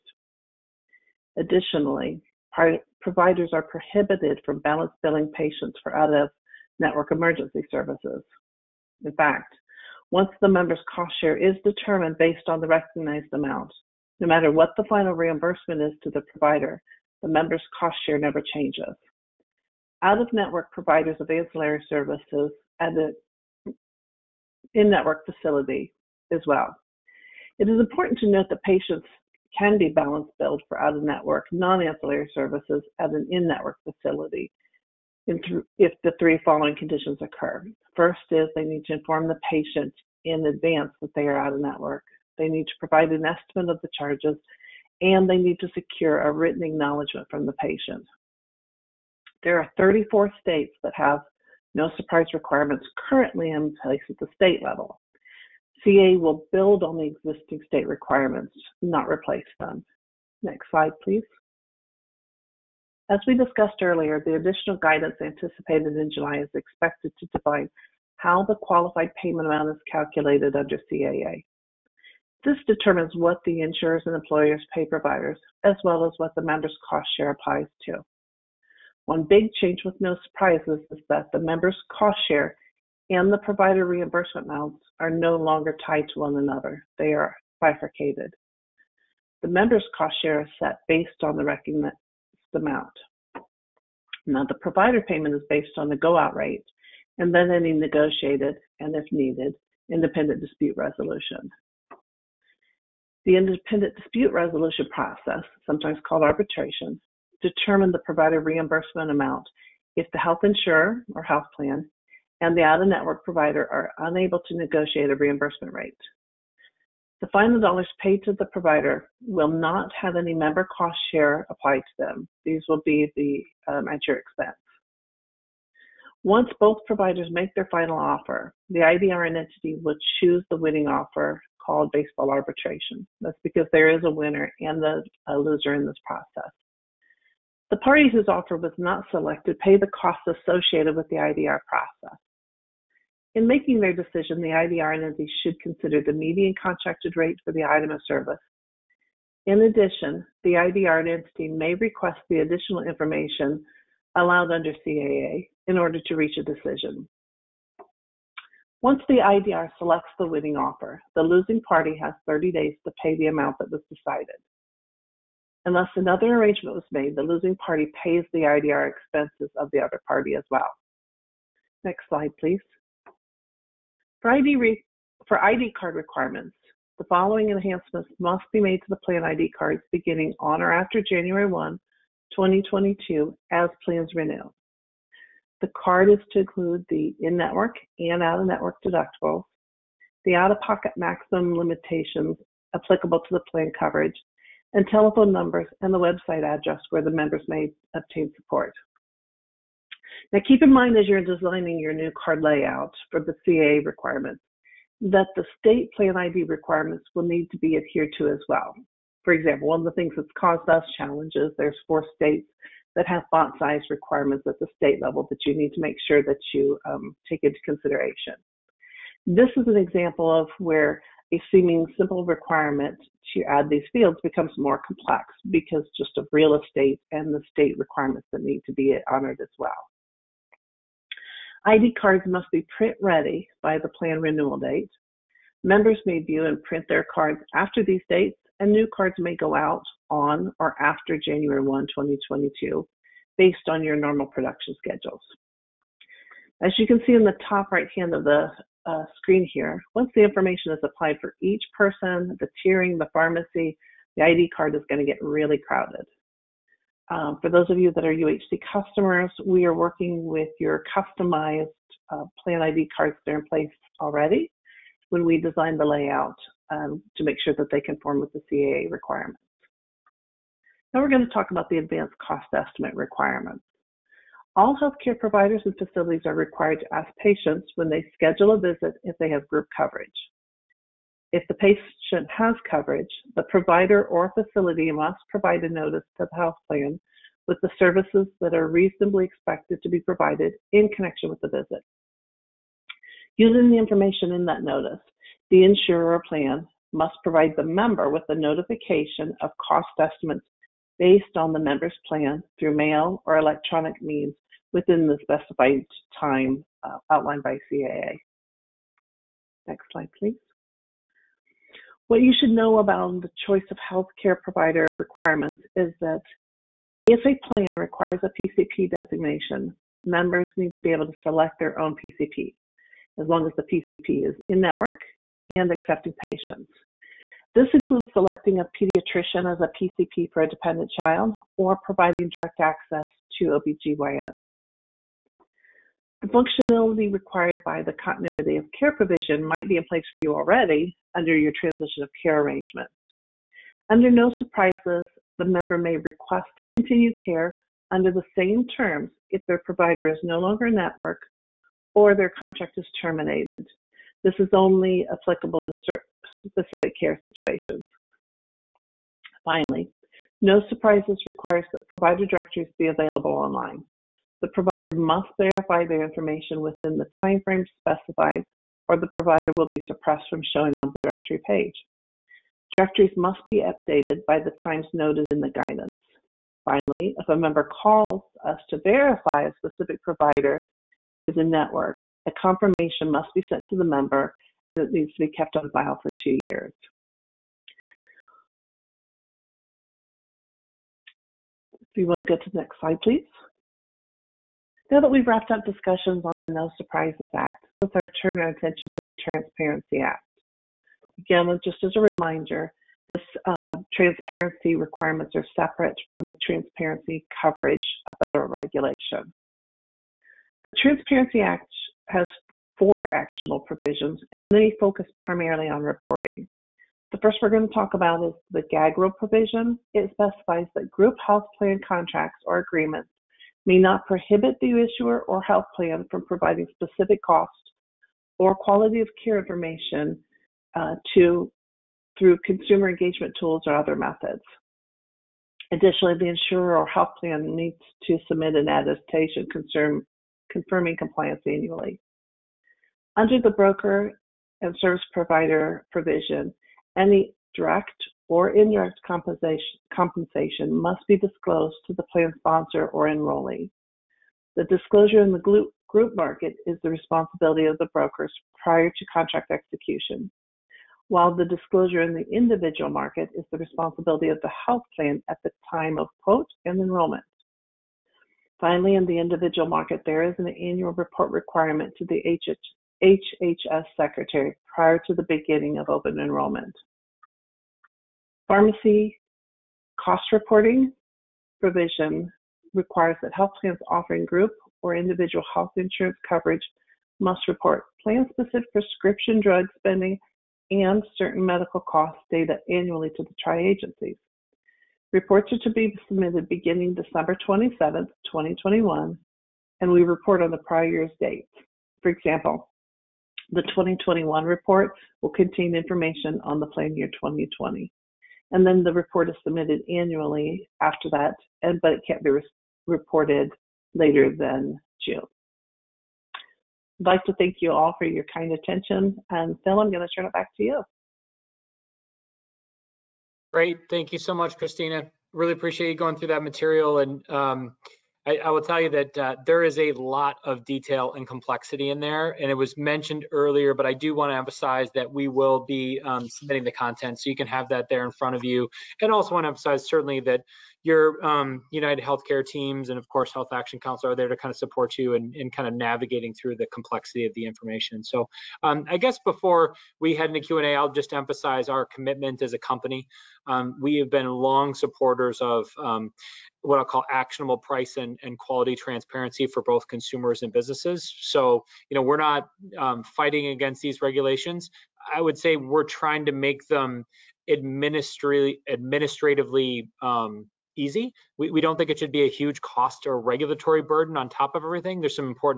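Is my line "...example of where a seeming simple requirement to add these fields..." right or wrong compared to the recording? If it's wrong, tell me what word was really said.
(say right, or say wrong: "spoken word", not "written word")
right.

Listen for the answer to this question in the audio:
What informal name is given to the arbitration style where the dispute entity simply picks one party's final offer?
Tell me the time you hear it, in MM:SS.
02:11.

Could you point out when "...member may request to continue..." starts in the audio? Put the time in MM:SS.
05:45.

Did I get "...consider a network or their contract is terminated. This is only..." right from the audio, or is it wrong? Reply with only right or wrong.
wrong.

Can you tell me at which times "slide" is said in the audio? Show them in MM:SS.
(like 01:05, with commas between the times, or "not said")
01:00, 02:52, 05:09, 06:32.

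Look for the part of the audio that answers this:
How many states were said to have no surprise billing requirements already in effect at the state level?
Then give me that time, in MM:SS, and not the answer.
00:49.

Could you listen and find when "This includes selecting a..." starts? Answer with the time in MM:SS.
05:27.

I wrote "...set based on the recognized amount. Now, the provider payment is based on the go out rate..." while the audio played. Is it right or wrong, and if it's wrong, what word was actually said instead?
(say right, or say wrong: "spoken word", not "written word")
right.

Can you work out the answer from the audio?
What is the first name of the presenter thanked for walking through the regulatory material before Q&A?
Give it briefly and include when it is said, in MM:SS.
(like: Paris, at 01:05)
Christina, at 08:44.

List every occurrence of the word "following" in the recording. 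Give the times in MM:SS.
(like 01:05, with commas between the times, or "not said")
00:36, 02:57.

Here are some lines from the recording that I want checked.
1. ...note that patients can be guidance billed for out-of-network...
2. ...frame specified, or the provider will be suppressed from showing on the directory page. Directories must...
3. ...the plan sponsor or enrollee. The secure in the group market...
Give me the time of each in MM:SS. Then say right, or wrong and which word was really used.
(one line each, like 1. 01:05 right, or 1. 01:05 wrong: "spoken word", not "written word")
1. 00:28 wrong: "balance", not "guidance"
2. 06:07 right
3. 07:31 wrong: "disclosure", not "secure".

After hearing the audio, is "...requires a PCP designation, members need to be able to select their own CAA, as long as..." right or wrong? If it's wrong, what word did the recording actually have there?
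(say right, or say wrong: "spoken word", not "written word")
wrong: "PCP", not "CAA".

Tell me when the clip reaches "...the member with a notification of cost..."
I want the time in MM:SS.
04:57.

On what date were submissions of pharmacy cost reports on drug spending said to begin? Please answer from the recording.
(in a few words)
December 27, 2021.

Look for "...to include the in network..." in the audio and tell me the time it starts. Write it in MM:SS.
03:06.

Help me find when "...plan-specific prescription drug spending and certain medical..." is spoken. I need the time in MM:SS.
08:08.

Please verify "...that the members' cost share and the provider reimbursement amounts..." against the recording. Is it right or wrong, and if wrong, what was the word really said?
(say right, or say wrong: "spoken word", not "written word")
right.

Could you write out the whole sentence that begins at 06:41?
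Again, just as a reminder, this uh, transparency requirements are separate from the transparency coverage of federal regulation.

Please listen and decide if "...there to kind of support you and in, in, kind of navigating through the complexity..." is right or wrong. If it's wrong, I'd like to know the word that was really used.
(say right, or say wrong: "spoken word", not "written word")
right.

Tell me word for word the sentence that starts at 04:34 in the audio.
All healthcare providers and facilities are required to ask patients when they schedule a visit if they have group coverage.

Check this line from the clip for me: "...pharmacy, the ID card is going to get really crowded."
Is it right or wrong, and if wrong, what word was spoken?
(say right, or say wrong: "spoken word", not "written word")
right.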